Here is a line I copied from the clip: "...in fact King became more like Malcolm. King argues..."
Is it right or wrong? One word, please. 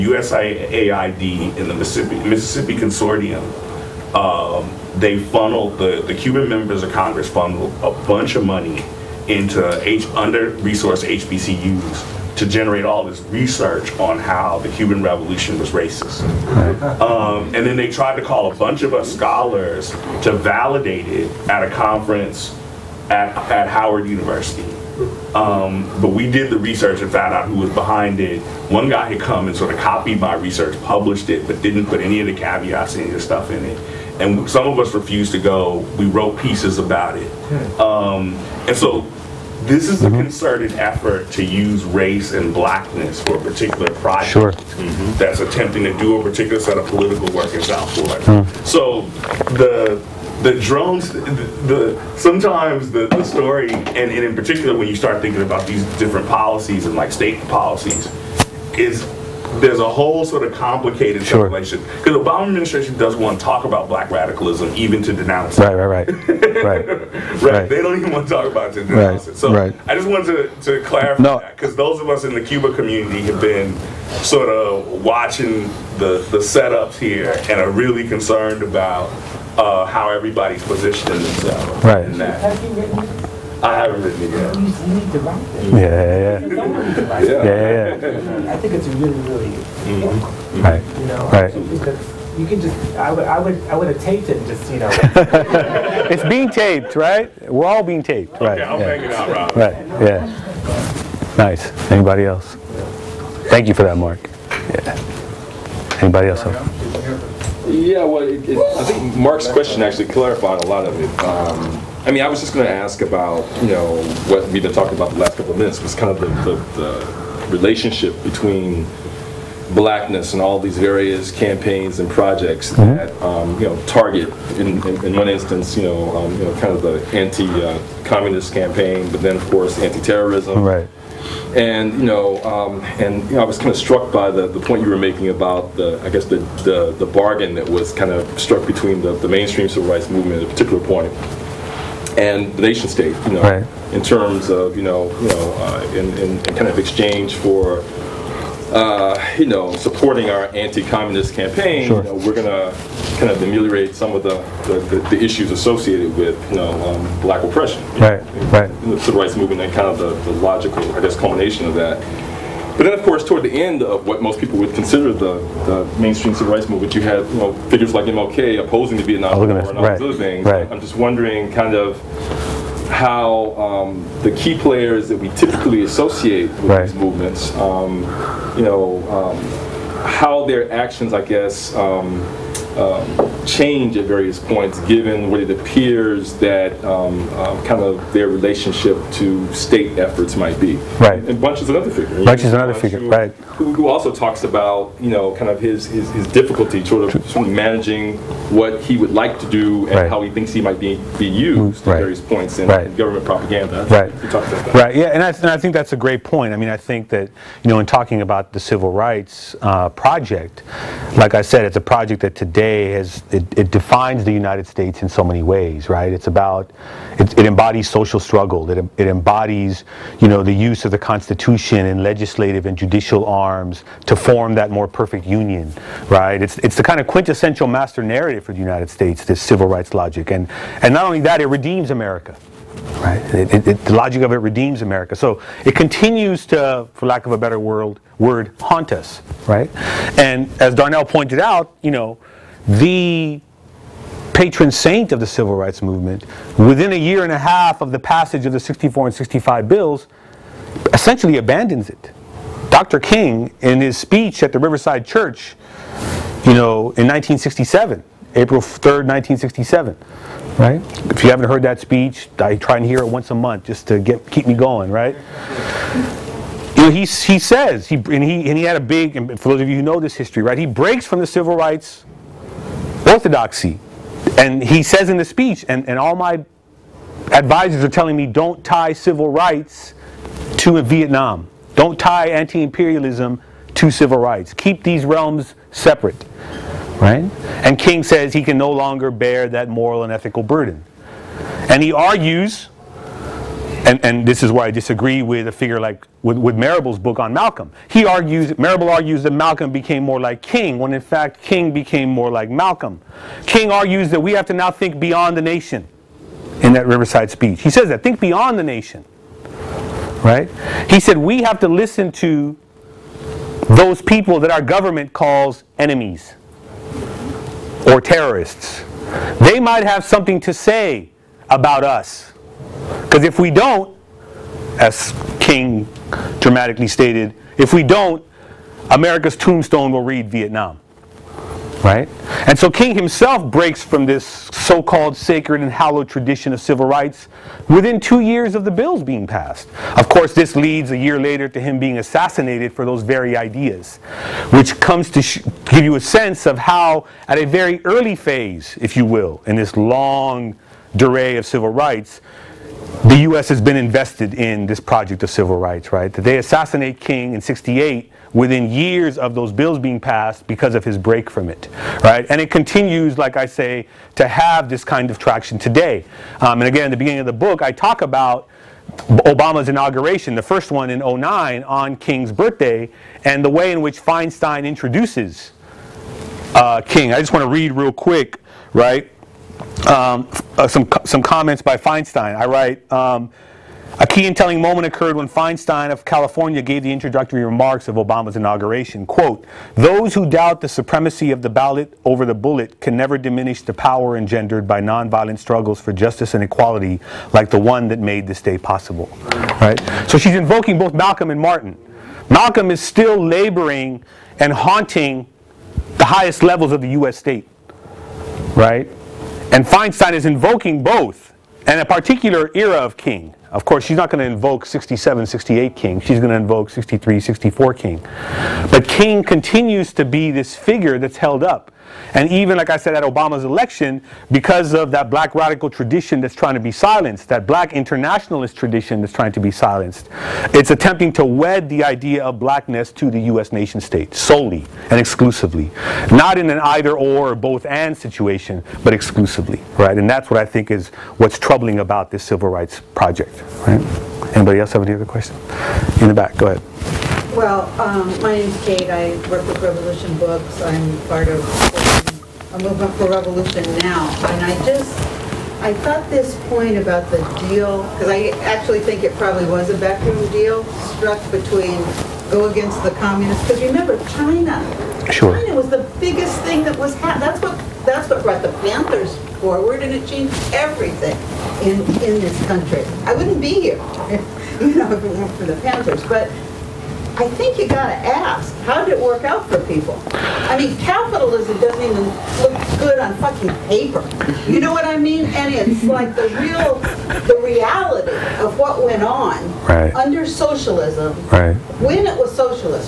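right.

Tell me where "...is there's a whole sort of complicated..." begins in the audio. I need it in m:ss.
0:58.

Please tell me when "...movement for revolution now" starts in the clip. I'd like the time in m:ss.
7:32.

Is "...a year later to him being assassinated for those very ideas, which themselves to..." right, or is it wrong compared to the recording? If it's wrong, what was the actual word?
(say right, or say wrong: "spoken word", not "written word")
wrong: "comes", not "themselves".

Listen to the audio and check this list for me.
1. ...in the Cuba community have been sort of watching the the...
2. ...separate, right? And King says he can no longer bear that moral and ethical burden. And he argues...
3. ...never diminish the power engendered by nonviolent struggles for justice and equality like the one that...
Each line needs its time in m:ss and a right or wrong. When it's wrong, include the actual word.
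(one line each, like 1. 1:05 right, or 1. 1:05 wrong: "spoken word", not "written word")
1. 1:12 right
2. 4:45 right
3. 6:32 right.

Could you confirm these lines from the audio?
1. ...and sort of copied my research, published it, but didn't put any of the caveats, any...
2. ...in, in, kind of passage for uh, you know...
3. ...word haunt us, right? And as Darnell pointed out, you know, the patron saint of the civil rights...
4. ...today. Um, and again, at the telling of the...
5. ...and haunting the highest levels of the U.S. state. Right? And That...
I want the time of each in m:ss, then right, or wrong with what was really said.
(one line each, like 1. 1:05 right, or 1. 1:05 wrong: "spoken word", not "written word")
1. 0:29 right
2. 2:26 wrong: "exchange", not "passage"
3. 3:58 right
4. 6:05 wrong: "beginning", not "telling"
5. 6:44 wrong: "Feinstein", not "That".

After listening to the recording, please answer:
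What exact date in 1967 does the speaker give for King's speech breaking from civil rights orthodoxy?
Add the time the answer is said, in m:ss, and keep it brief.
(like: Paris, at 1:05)
April 3rd, 1967, at 4:18.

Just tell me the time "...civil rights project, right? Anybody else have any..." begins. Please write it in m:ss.
7:22.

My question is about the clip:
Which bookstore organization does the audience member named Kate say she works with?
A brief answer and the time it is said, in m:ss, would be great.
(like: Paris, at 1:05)
Revolution Books, at 7:29.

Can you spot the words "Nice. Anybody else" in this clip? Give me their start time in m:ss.
1:41.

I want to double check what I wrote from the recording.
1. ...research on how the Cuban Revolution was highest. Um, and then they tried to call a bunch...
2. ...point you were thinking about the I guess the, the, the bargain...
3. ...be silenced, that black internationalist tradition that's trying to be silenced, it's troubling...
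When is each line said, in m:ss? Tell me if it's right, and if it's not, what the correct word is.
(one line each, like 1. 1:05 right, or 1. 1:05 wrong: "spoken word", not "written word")
1. 0:13 wrong: "racist", not "highest"
2. 2:14 wrong: "making", not "thinking"
3. 7:06 wrong: "attempting", not "troubling".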